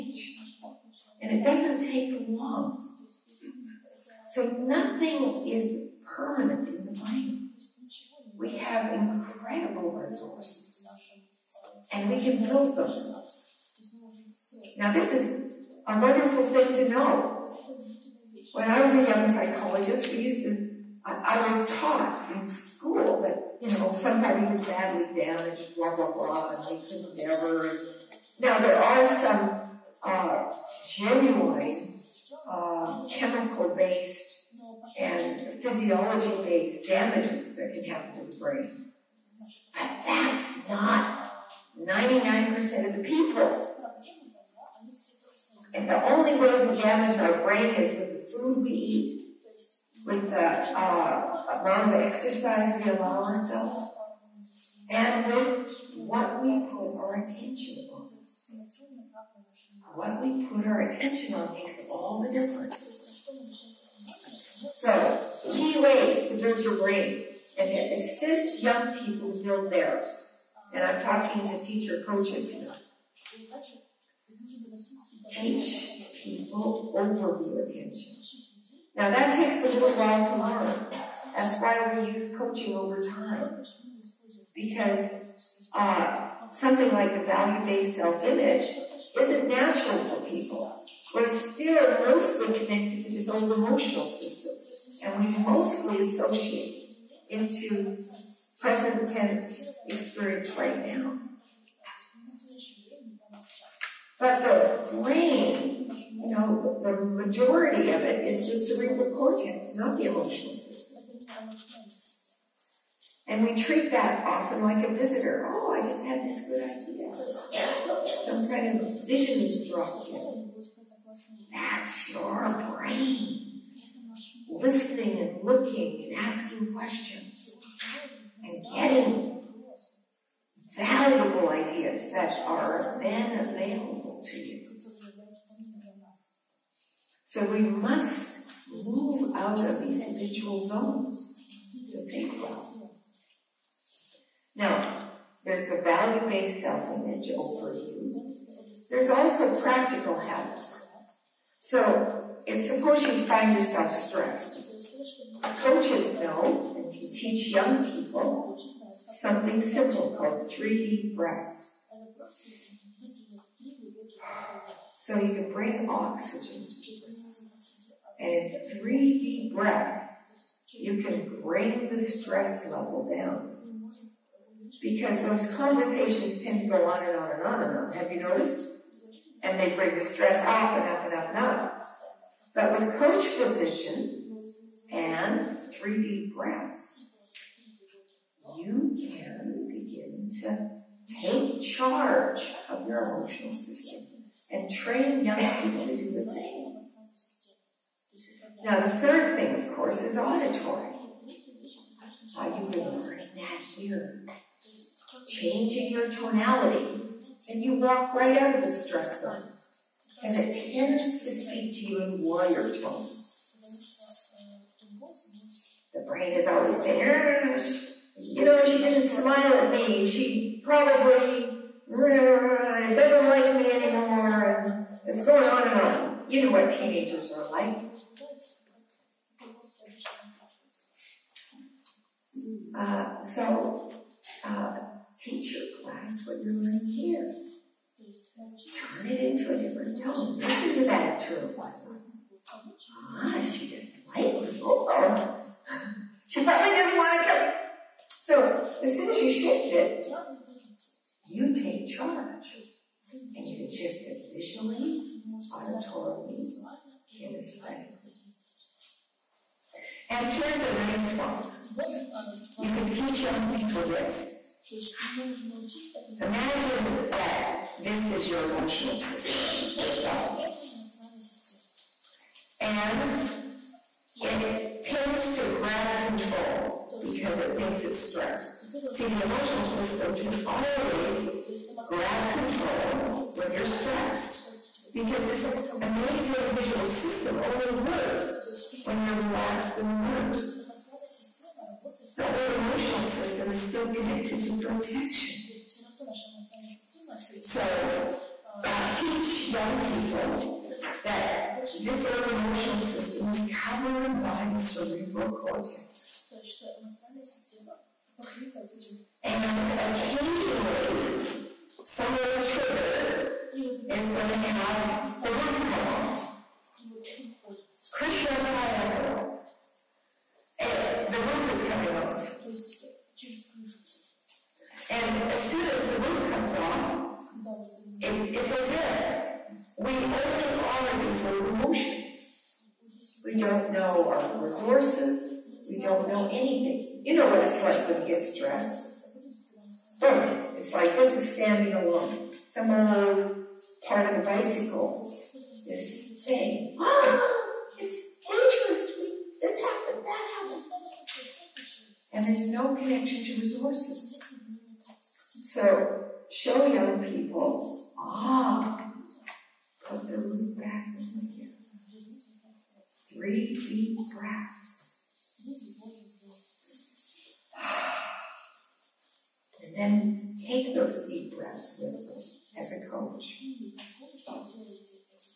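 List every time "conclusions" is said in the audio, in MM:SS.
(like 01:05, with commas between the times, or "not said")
not said.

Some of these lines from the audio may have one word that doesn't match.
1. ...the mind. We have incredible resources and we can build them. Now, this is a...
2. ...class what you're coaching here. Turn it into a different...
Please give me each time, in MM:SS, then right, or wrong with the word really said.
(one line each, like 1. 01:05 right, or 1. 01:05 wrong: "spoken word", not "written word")
1. 00:06 right
2. 03:55 wrong: "learning", not "coaching".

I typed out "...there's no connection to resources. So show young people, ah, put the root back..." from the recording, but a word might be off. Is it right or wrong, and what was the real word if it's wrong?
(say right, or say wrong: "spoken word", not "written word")
right.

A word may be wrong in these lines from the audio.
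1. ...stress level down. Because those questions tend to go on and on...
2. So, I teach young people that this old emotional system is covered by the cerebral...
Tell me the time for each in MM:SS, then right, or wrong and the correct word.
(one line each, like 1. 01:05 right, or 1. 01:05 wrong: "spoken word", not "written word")
1. 02:52 wrong: "conversations", not "questions"
2. 04:57 right.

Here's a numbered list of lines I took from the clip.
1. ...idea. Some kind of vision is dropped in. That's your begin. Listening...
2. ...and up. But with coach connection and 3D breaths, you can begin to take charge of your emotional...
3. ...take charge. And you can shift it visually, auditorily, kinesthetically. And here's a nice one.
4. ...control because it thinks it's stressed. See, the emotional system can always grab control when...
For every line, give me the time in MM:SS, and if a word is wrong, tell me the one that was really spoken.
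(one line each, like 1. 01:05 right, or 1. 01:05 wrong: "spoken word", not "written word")
1. 01:56 wrong: "brain", not "begin"
2. 03:01 wrong: "position", not "connection"
3. 04:11 right
4. 04:36 right.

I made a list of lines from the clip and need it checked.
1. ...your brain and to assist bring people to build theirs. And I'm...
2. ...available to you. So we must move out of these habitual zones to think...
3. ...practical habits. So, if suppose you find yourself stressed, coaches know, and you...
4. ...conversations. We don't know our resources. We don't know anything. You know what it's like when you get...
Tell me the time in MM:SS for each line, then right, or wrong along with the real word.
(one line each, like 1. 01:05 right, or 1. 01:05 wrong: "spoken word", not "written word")
1. 01:06 wrong: "young", not "bring"
2. 02:13 right
3. 02:29 right
4. 05:31 wrong: "emotions", not "conversations".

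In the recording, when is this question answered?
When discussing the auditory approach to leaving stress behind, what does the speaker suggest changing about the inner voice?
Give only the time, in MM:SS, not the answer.
03:26.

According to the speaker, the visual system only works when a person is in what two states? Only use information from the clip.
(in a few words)
relaxed and alert.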